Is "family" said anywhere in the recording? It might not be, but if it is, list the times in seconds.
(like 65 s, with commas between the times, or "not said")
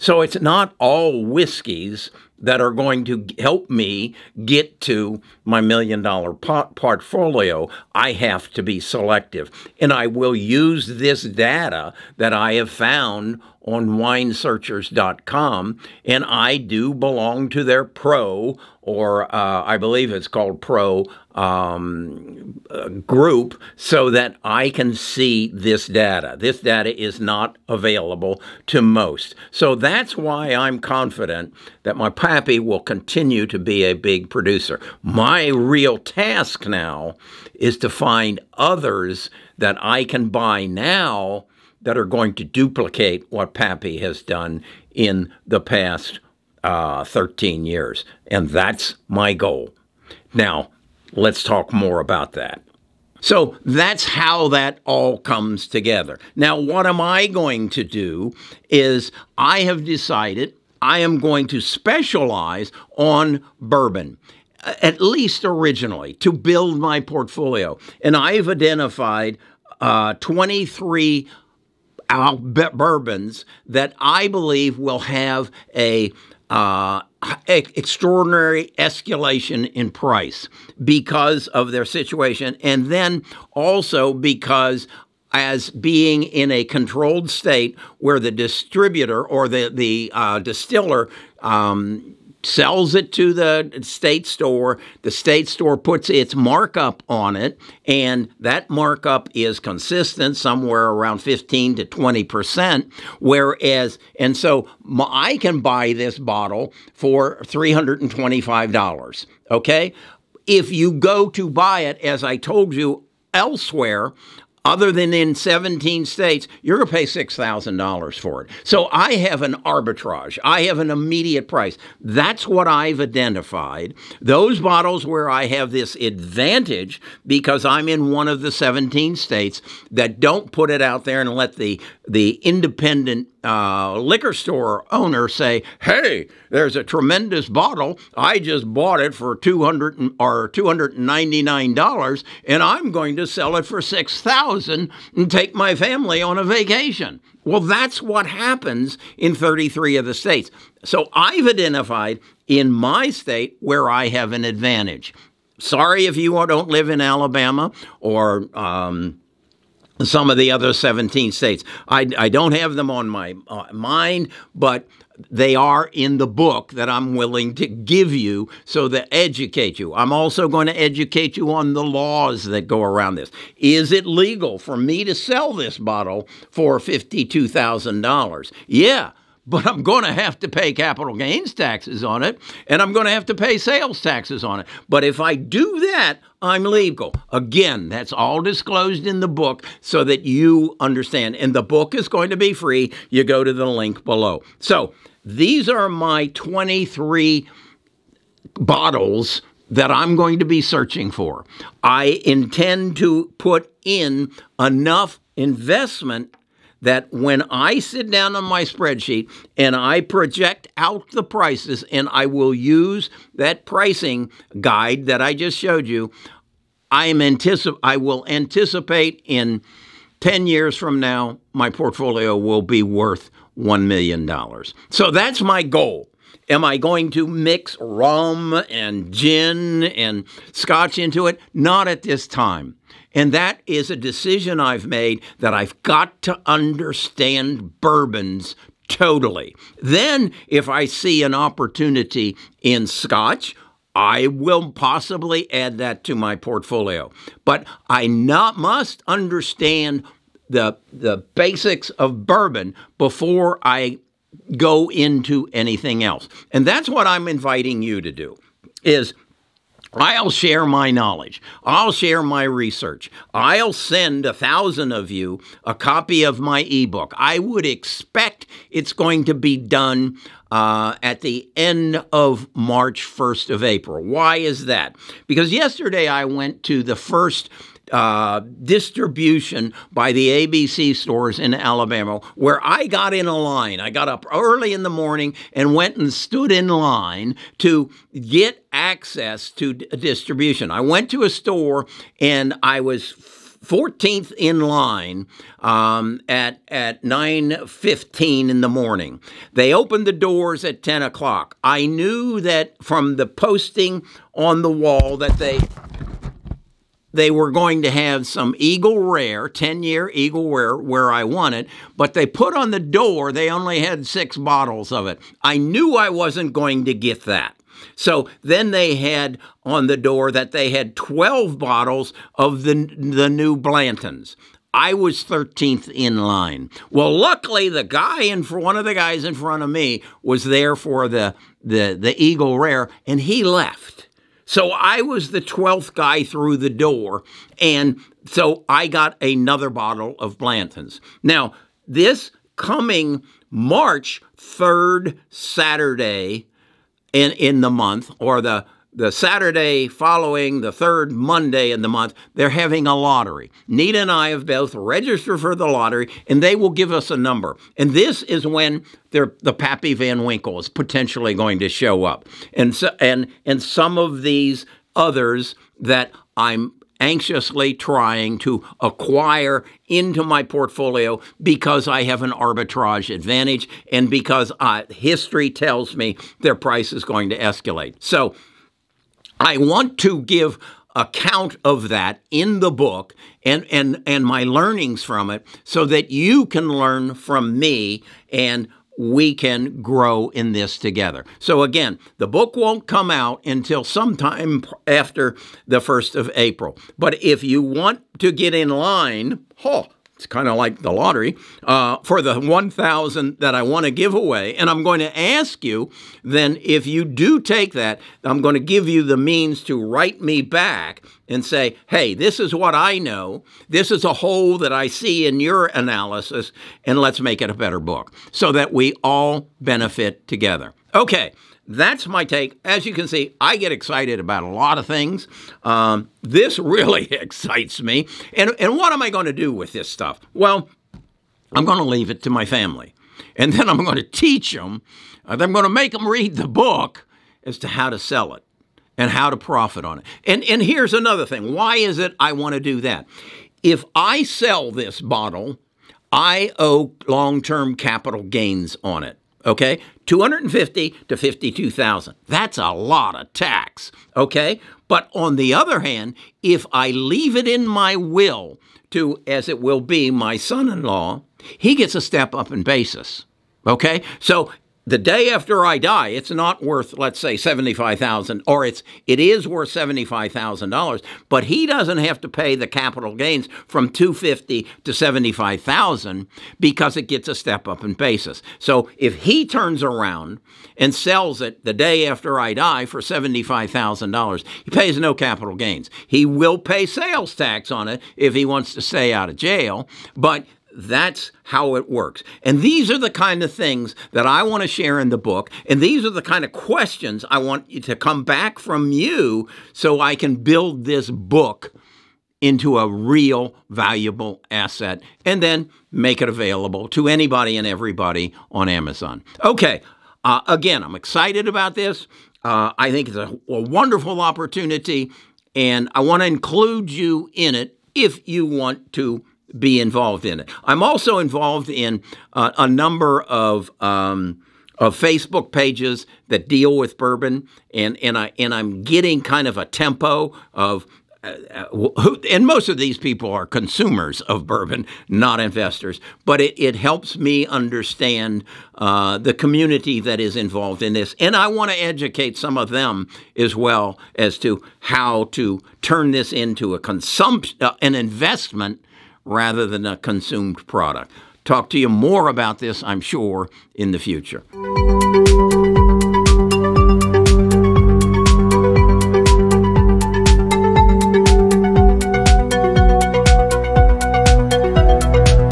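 145 s, 432 s.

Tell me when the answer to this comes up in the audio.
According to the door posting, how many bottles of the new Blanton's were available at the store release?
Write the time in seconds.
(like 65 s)
320 s.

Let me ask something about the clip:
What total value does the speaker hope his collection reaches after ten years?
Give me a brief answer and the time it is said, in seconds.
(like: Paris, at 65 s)
$1 million, at 223 s.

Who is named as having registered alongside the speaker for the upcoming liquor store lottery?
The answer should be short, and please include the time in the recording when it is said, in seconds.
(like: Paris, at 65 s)
Nita, at 353 s.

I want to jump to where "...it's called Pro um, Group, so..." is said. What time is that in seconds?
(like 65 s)
20 s.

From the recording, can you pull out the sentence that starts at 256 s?
And that's what I'm inviting you to do is I'll share my knowledge.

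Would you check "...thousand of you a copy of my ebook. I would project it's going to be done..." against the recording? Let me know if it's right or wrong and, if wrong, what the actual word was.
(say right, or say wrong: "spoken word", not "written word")
wrong: "expect", not "project".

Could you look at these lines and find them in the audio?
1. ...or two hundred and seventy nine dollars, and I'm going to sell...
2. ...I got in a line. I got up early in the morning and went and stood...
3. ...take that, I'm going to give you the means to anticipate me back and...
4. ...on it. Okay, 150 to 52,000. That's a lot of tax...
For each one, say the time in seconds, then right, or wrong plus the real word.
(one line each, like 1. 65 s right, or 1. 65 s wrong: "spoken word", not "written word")
1. 140 s wrong: "ninety", not "seventy"
2. 282 s right
3. 407 s wrong: "write", not "anticipate"
4. 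448 s wrong: "250", not "150".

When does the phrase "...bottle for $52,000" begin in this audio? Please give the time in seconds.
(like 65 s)
175 s.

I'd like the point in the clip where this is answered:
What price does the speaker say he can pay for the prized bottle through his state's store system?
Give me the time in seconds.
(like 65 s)
107 s.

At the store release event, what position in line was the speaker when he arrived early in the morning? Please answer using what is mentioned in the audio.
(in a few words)
14th.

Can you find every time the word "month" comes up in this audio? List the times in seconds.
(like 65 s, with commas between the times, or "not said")
347 s, 351 s.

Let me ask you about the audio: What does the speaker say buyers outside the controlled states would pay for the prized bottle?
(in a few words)
$6,000.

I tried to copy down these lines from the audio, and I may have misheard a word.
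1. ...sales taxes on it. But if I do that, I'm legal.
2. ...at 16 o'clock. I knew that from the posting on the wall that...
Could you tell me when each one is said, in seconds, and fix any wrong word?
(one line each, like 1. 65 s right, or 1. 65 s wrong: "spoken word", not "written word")
1. 183 s right
2. 300 s wrong: "10", not "16".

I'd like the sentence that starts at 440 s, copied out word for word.
And, and here's another thing why is it I want to do that?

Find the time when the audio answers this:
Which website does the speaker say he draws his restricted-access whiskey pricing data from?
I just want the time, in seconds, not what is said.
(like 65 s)
13 s.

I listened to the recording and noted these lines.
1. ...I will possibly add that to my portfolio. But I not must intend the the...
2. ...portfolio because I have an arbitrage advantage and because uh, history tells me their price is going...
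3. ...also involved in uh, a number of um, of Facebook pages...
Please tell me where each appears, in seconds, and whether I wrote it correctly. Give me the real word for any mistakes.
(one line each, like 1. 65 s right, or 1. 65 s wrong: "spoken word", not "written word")
1. 243 s wrong: "understand", not "intend"
2. 370 s right
3. 520 s right.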